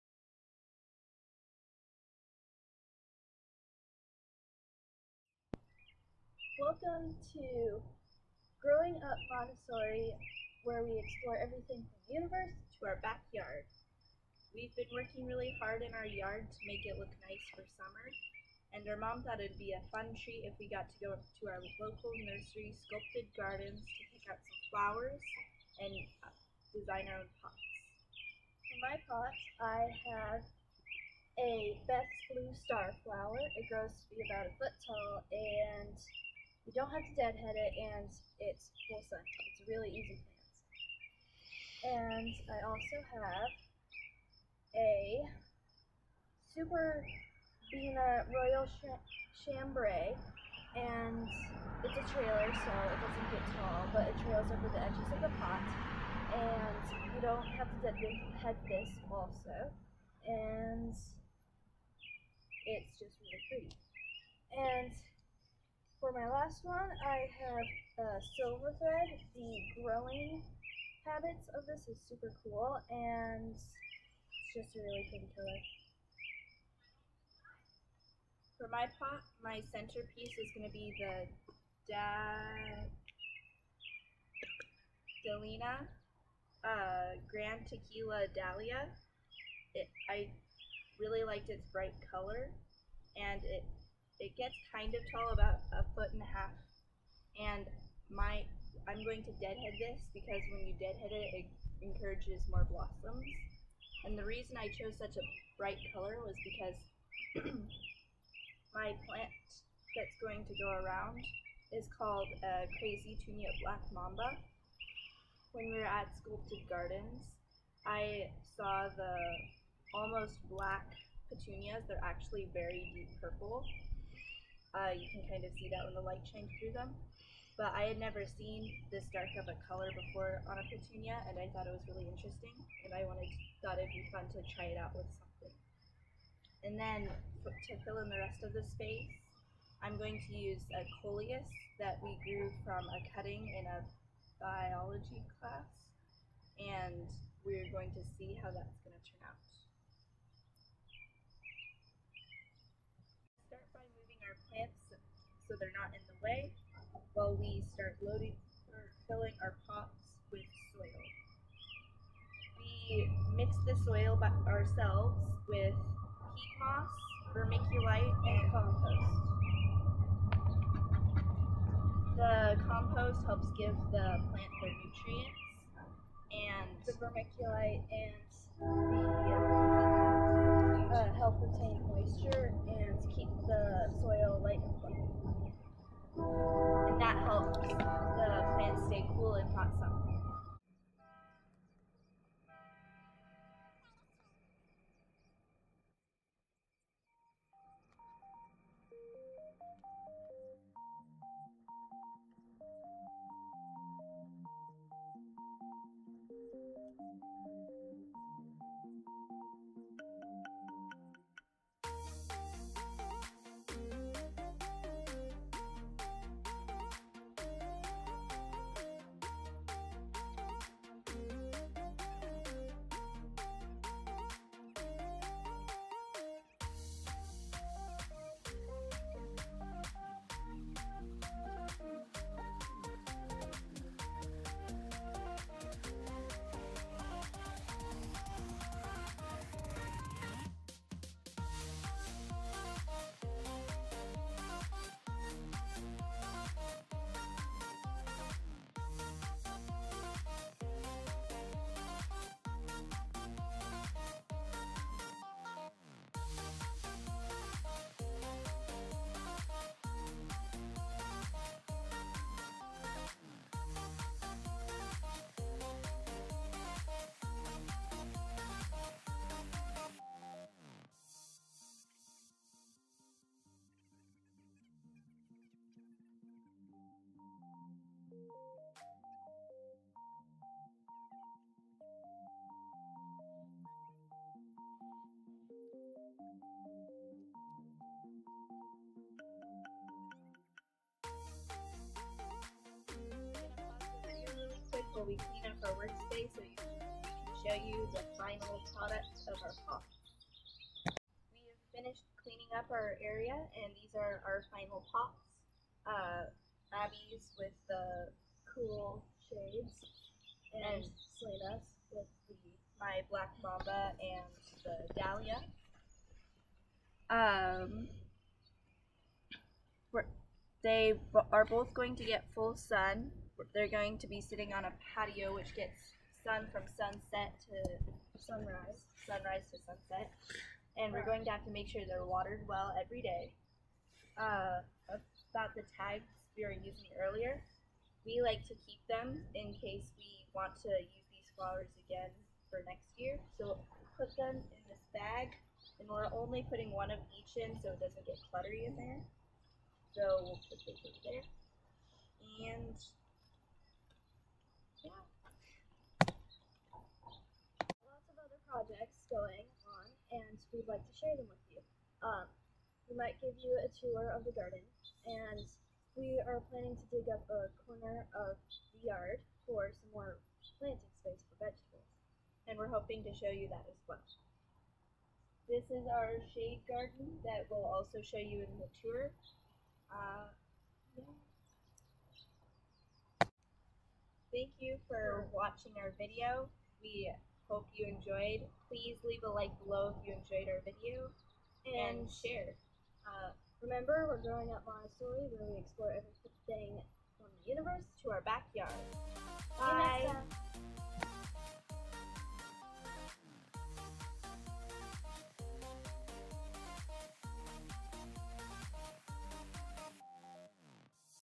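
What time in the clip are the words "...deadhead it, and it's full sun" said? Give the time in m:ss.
0:37.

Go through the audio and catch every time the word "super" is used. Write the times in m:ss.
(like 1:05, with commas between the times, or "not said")
0:46, 1:12.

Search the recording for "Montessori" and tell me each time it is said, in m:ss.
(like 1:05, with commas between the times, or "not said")
0:09, 6:34.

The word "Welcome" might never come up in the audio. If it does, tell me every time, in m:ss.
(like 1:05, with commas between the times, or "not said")
0:06.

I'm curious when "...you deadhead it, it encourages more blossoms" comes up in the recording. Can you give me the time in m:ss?
1:40.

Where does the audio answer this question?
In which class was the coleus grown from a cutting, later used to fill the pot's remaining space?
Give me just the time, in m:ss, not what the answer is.
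2:24.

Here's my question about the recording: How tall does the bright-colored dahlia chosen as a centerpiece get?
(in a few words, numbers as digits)
A foot and a half.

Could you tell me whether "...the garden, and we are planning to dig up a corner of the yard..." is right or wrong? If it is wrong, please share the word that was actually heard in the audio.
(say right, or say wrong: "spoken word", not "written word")
right.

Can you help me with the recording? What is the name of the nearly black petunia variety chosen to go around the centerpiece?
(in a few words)
Crazy Tunia Black Mamba.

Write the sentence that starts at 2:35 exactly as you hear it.
so they're not in the way while we start loading or filling our pots with soil.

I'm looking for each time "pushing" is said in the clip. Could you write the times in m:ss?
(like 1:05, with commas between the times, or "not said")
not said.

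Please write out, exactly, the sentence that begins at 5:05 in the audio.
Uh, Abby's with the cool shades and Selena's with the my black mamba and the dahlia.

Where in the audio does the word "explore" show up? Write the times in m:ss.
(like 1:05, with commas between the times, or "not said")
0:10, 6:35.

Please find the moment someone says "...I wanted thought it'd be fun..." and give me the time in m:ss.
2:12.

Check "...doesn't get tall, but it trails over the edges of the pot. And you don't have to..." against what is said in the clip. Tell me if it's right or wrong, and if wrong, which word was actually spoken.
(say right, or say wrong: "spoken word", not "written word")
right.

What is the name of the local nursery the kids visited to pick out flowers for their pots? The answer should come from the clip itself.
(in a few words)
Sculptured Gardens.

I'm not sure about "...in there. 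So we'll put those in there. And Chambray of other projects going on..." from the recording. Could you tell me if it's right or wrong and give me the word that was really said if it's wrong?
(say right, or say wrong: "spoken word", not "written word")
wrong: "Lots", not "Chambray".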